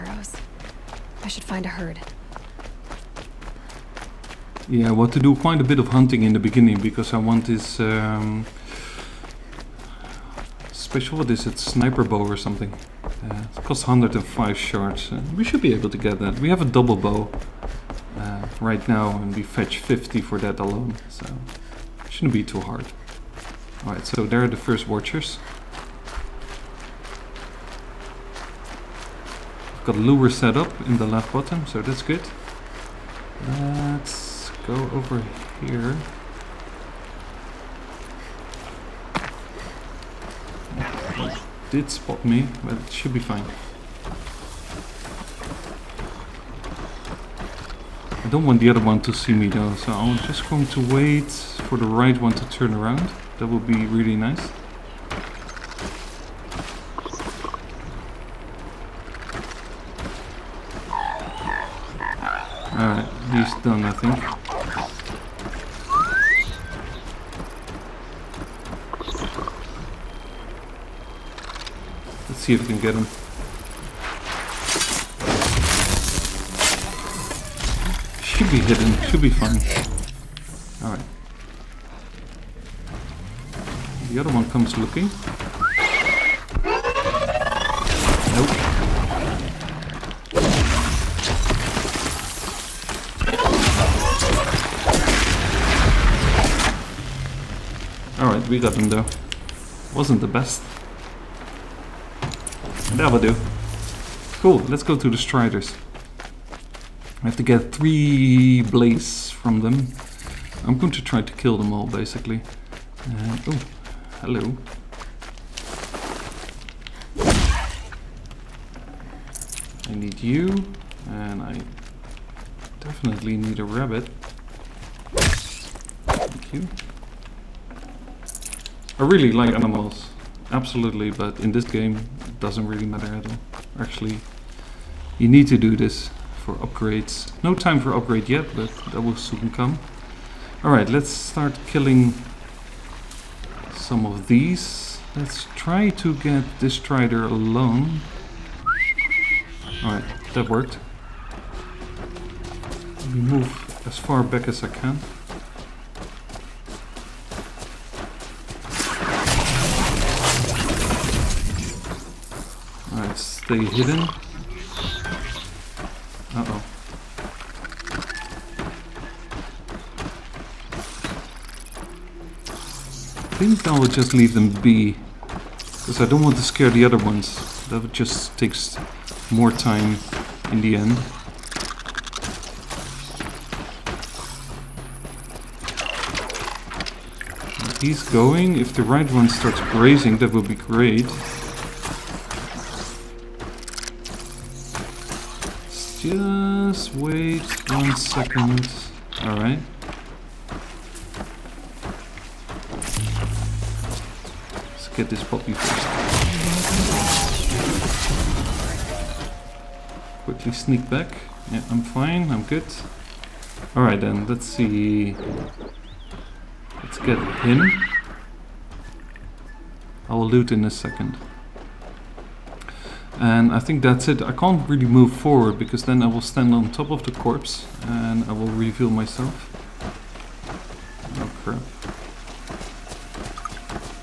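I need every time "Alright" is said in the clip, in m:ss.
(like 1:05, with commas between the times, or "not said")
0:23, 1:02, 1:20, 1:38, 2:20, 2:29, 3:19, 3:33.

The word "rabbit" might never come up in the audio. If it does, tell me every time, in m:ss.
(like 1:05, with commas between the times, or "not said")
2:03.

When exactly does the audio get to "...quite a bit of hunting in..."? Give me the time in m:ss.
0:05.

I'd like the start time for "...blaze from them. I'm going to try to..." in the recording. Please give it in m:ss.
1:48.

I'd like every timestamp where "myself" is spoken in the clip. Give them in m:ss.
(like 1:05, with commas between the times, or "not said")
3:48.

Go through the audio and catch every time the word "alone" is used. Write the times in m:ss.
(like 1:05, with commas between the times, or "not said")
0:20, 2:27.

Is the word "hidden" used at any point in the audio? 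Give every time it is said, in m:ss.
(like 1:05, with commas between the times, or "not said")
1:18, 2:43.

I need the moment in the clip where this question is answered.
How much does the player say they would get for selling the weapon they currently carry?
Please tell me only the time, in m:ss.
0:19.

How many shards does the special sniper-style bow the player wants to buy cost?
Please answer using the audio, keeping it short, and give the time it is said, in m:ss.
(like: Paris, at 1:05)
105, at 0:13.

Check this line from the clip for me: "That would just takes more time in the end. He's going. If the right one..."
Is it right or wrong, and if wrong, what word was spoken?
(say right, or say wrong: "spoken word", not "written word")
right.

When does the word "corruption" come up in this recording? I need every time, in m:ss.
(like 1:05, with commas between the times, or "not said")
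not said.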